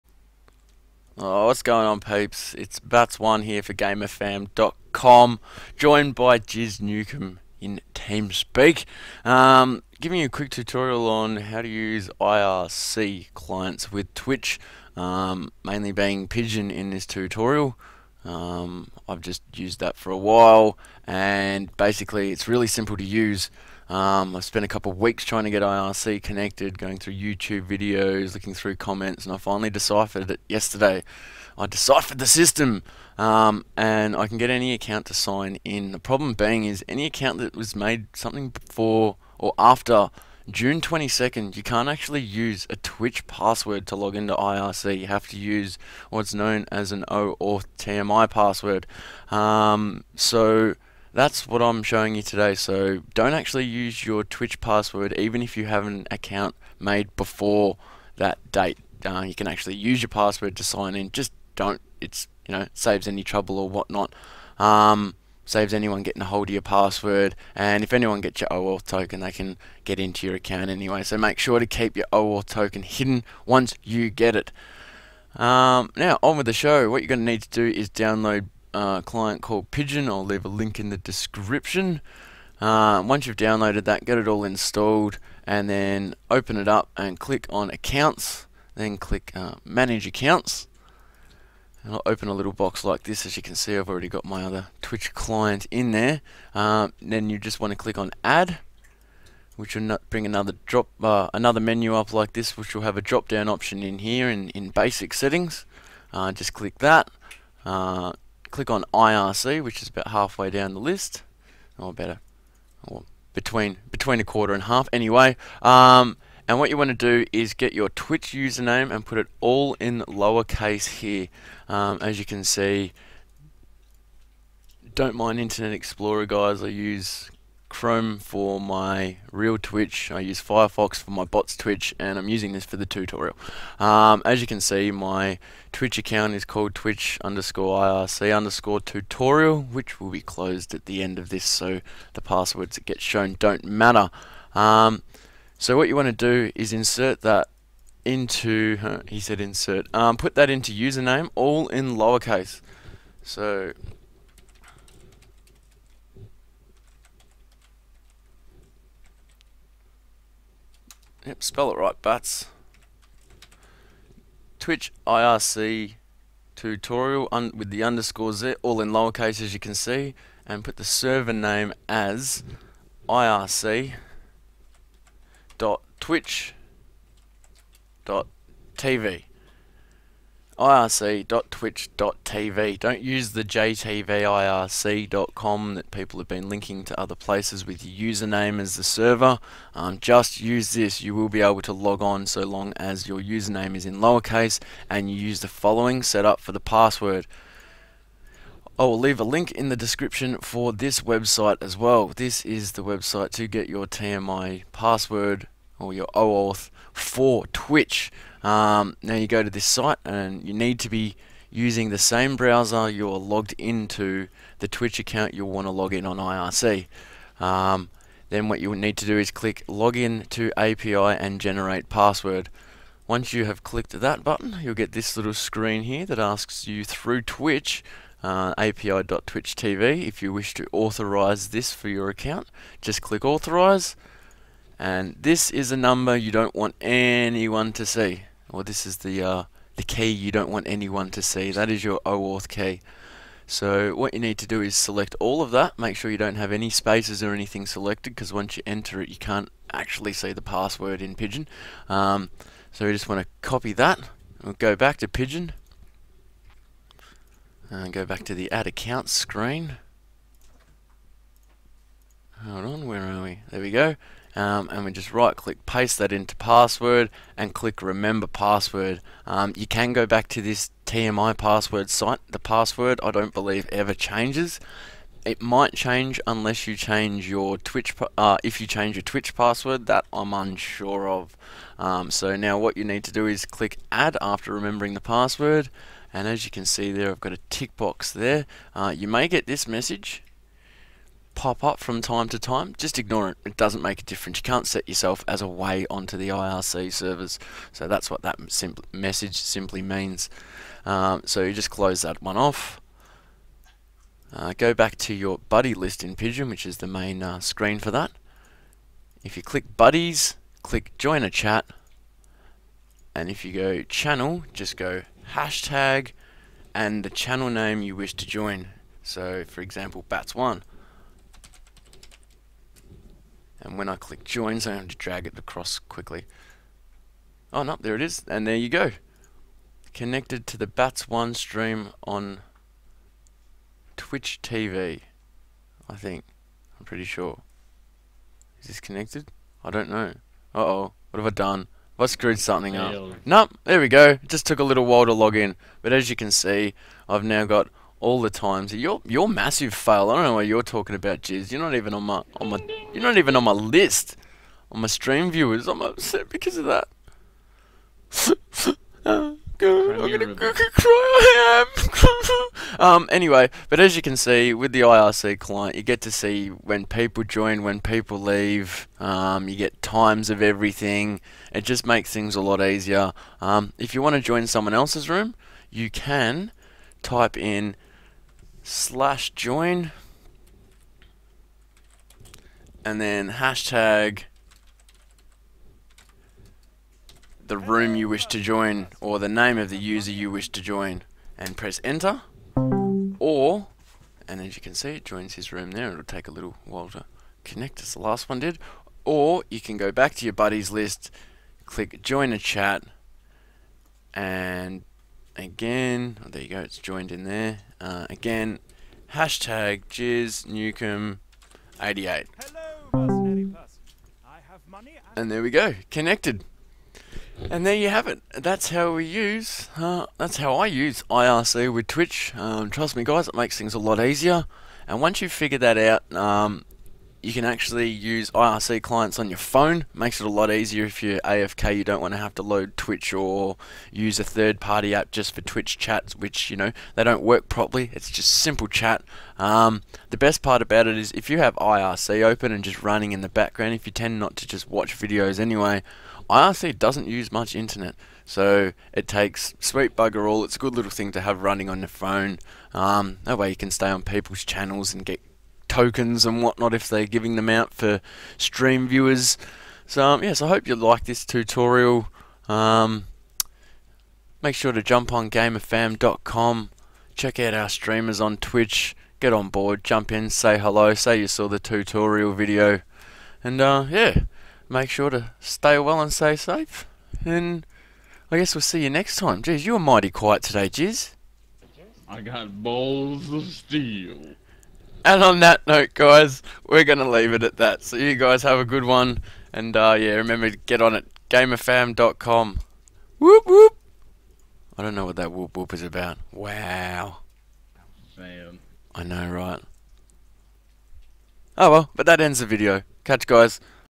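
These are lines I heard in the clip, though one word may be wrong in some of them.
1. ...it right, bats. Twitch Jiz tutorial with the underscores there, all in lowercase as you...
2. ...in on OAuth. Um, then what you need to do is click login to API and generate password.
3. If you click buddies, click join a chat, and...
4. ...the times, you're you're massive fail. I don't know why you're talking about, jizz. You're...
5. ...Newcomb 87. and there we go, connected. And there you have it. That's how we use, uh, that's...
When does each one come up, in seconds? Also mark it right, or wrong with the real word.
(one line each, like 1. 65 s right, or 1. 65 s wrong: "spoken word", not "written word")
1. 161 s wrong: "IRC", not "Jiz"
2. 215 s wrong: "IRC", not "OAuth"
3. 309 s right
4. 348 s right
5. 410 s wrong: "88", not "87".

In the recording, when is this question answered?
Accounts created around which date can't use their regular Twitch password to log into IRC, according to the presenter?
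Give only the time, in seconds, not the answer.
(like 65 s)
40 s.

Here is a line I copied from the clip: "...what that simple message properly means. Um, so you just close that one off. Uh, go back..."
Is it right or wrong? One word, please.
wrong.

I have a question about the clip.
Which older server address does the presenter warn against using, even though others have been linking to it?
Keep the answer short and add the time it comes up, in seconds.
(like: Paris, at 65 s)
jtvirc.com, at 183 s.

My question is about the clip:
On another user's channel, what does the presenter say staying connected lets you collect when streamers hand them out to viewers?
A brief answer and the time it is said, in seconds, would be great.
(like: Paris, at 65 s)
tokens, at 455 s.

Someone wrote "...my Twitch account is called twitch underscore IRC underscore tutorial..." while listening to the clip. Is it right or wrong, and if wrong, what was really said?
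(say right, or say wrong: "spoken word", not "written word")
right.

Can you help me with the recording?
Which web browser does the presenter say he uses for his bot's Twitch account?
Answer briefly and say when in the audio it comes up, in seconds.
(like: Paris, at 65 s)
Firefox, at 130 s.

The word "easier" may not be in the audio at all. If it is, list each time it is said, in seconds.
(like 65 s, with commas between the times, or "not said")
372 s, 423 s, 430 s.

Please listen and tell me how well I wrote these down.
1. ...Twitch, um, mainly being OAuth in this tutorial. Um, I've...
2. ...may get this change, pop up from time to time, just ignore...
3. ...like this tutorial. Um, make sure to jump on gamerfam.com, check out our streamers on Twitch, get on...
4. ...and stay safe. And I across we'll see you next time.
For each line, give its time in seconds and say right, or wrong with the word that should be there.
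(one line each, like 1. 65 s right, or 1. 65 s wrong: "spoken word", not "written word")
1. 14 s wrong: "Pidgin", not "OAuth"
2. 289 s wrong: "message", not "change"
3. 460 s right
4. 476 s wrong: "guess", not "across".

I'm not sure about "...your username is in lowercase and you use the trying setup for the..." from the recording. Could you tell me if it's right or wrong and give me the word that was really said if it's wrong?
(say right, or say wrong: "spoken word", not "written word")
wrong: "following", not "trying".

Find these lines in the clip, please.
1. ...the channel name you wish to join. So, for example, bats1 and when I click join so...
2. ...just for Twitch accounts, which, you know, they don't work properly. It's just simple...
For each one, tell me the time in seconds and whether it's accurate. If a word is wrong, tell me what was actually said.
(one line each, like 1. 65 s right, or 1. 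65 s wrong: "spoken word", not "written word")
1. 317 s right
2. 435 s wrong: "chats", not "accounts".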